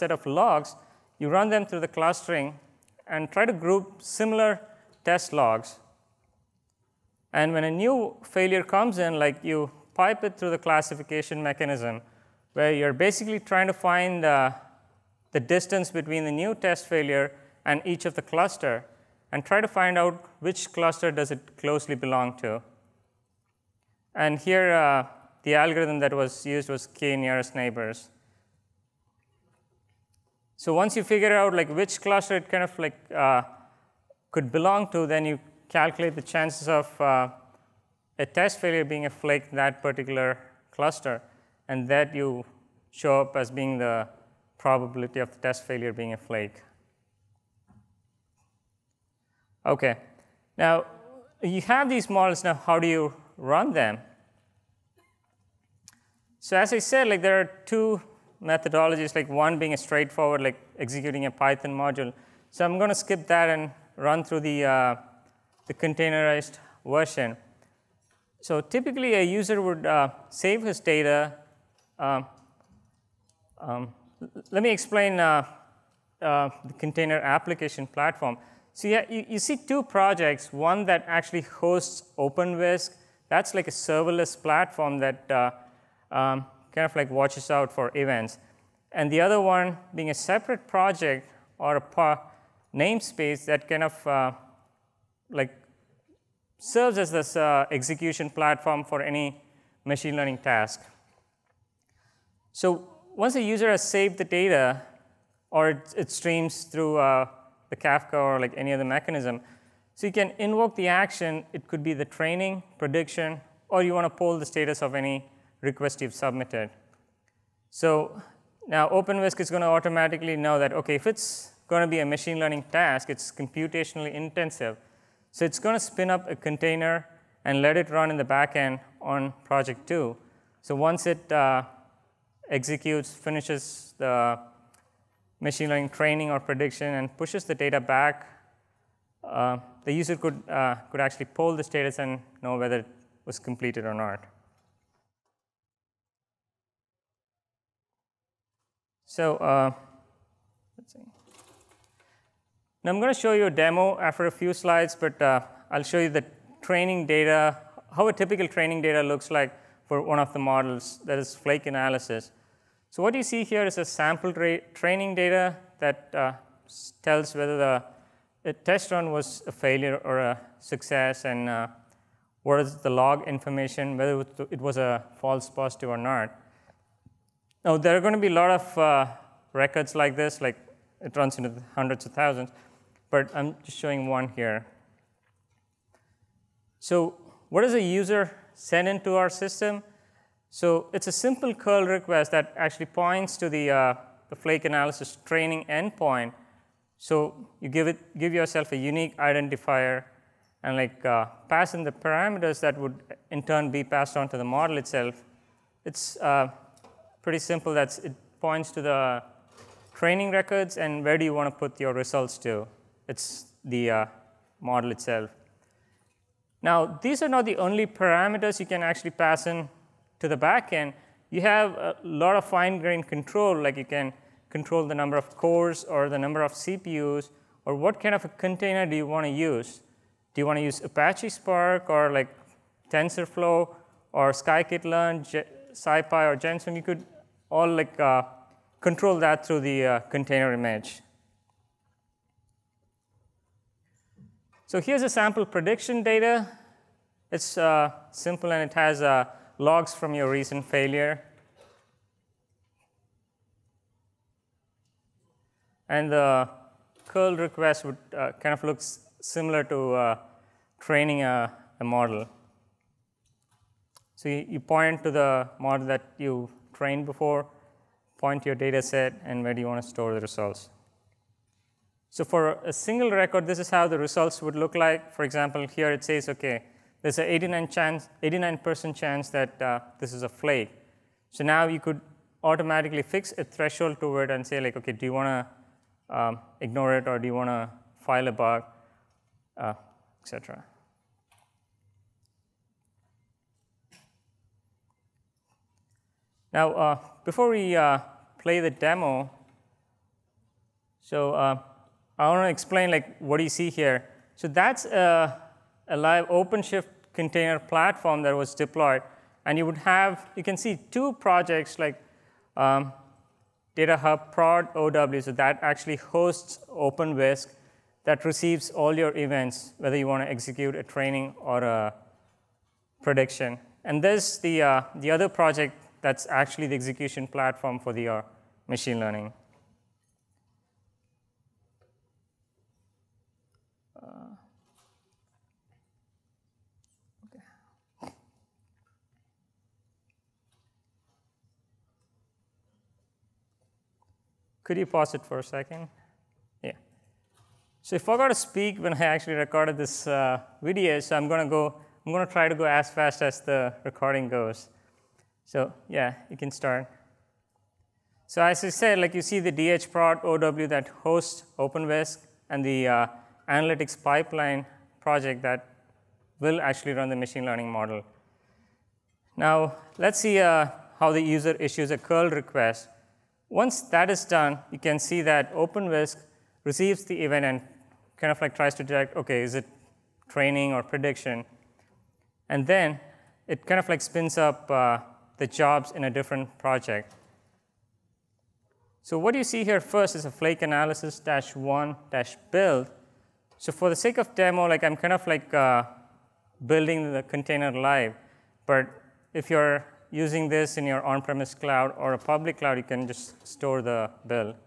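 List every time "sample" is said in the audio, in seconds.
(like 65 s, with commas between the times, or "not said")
163 s, 245 s.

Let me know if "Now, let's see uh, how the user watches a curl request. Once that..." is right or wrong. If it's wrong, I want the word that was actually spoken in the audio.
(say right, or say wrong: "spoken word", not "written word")
wrong: "issues", not "watches".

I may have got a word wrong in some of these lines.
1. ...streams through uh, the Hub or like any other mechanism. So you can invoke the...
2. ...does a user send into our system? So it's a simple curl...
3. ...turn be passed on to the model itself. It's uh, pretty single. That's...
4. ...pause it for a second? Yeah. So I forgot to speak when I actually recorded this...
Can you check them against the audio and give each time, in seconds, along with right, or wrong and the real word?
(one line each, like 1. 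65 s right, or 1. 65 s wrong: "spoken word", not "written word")
1. 106 s wrong: "Kafka", not "Hub"
2. 187 s right
3. 203 s wrong: "simple", not "single"
4. 344 s right.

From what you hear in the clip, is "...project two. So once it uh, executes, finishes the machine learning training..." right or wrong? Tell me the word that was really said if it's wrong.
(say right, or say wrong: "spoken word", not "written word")
right.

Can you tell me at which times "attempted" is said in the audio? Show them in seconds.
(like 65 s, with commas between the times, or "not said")
not said.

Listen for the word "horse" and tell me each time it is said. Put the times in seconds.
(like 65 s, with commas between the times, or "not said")
not said.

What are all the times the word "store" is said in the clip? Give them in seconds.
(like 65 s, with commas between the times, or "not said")
269 s, 403 s.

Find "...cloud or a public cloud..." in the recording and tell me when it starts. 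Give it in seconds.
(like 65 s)
401 s.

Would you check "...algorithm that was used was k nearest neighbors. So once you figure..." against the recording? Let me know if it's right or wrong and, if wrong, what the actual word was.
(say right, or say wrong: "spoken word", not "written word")
right.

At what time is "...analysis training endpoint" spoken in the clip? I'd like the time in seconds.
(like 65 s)
194 s.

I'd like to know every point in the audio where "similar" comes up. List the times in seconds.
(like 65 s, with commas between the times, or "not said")
4 s, 259 s.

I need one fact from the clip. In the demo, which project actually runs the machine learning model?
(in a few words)
analytics pipeline.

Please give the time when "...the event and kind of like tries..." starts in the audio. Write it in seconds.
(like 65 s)
377 s.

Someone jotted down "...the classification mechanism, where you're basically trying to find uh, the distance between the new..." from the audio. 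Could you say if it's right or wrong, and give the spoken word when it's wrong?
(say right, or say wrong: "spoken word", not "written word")
right.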